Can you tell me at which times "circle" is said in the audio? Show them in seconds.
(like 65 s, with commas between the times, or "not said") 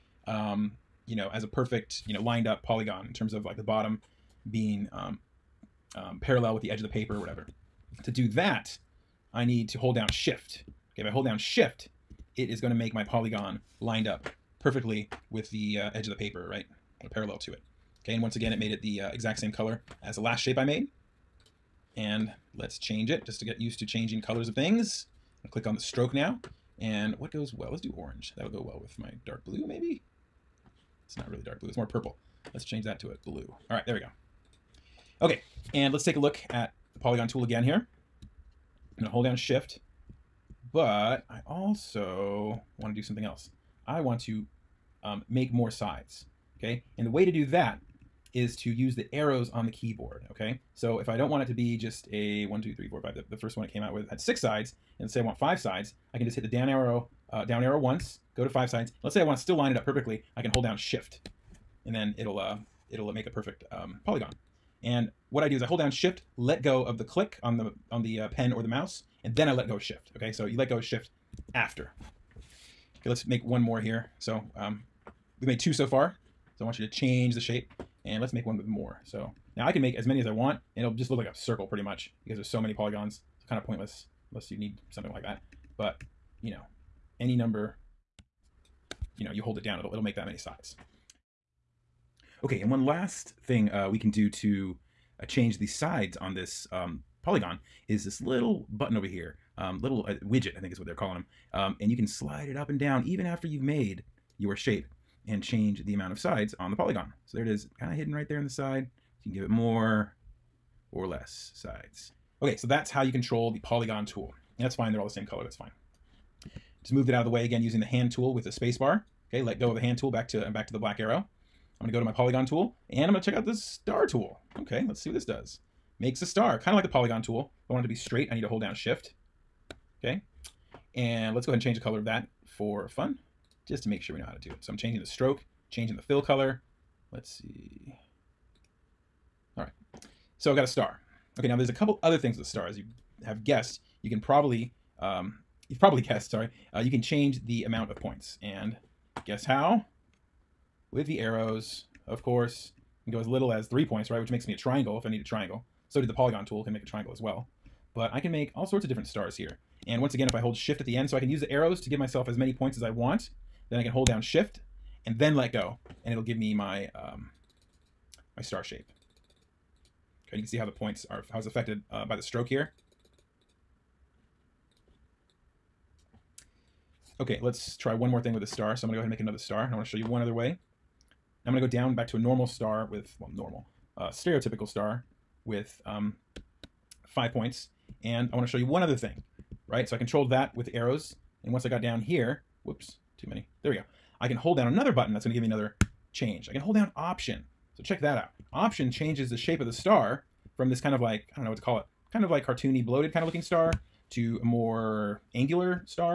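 81 s.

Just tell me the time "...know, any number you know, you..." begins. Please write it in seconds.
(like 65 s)
86 s.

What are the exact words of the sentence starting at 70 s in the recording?
Okay, so you let go of shift after.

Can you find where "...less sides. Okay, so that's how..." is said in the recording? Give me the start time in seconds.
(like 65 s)
111 s.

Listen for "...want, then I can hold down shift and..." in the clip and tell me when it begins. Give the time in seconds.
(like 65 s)
162 s.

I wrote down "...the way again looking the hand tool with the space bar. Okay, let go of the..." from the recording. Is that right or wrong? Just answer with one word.
wrong.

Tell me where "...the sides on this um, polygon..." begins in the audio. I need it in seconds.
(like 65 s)
95 s.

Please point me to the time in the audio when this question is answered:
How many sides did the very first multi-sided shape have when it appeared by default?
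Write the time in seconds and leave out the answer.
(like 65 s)
54 s.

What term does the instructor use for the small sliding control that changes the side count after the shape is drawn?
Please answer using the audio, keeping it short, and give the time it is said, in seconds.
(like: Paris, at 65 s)
widget, at 100 s.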